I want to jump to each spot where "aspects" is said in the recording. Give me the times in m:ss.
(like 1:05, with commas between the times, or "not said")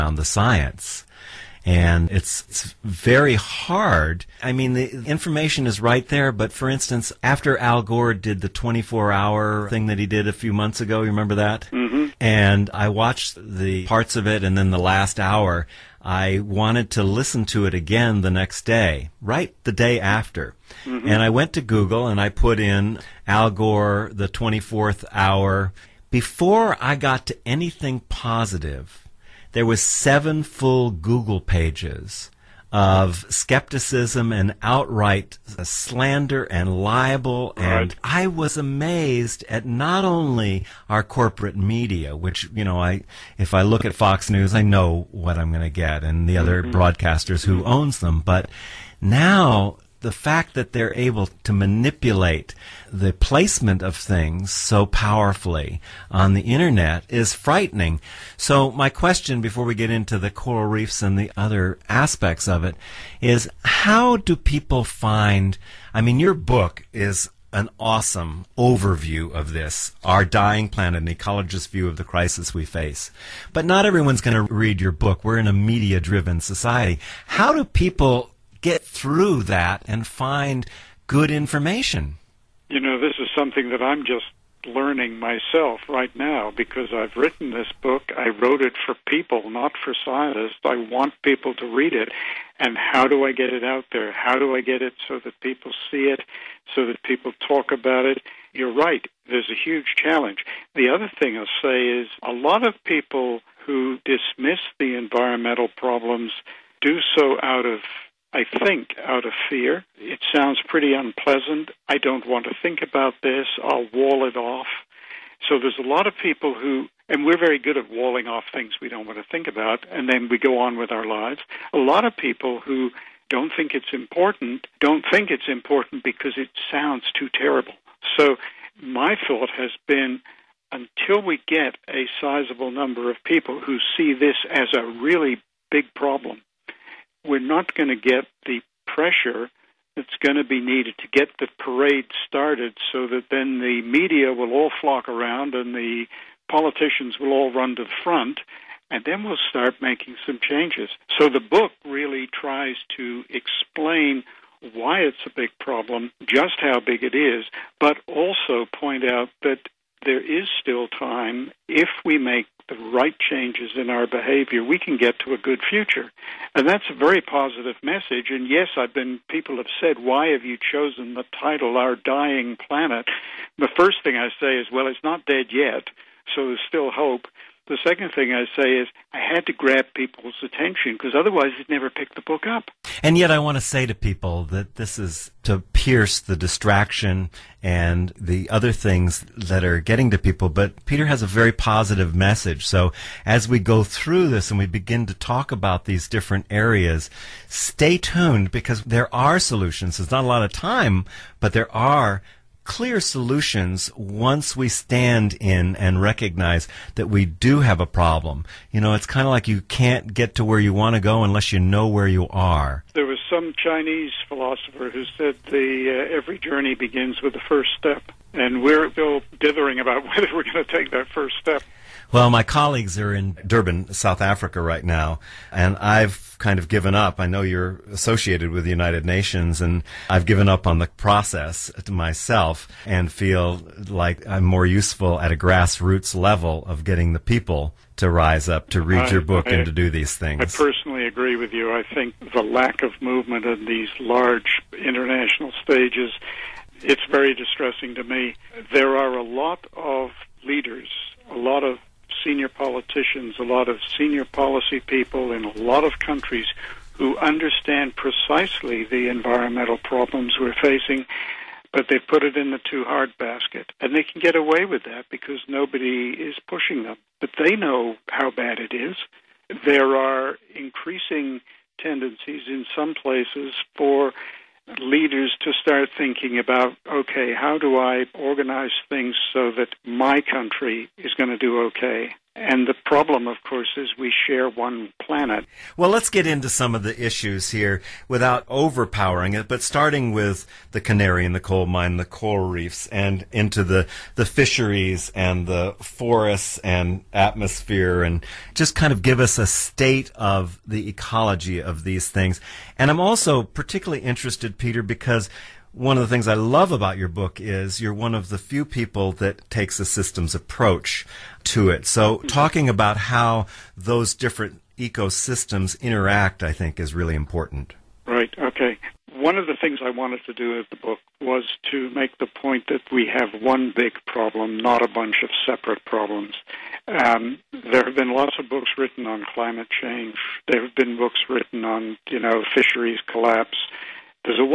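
1:01.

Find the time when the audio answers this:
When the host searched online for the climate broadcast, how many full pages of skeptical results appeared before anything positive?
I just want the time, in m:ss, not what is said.
0:29.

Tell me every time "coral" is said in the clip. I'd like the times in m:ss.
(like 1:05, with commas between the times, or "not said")
1:00, 4:52.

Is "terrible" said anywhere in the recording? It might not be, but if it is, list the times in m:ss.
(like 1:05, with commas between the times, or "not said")
2:07.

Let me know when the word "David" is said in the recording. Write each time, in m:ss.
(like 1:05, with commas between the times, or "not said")
not said.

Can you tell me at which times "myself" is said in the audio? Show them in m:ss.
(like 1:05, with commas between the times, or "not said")
1:25, 3:51.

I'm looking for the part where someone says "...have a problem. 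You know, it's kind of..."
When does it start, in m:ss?
3:27.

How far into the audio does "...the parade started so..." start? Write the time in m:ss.
2:21.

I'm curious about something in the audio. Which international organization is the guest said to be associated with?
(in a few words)
United Nations.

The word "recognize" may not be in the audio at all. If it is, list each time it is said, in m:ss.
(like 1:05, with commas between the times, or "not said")
3:26.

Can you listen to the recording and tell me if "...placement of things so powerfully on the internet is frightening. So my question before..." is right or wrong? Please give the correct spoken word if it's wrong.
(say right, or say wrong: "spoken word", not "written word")
right.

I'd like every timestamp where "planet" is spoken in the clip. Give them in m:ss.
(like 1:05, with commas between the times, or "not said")
1:10, 2:52, 4:45.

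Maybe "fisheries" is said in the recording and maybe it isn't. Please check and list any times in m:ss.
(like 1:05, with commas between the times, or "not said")
4:54, 5:32.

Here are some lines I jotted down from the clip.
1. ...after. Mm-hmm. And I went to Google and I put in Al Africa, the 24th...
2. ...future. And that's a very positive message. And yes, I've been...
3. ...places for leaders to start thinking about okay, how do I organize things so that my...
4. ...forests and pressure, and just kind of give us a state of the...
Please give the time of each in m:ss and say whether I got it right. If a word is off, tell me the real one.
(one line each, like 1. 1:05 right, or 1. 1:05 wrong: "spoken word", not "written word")
1. 0:19 wrong: "Gore", not "Africa"
2. 2:45 right
3. 4:32 right
4. 4:55 wrong: "atmosphere", not "pressure".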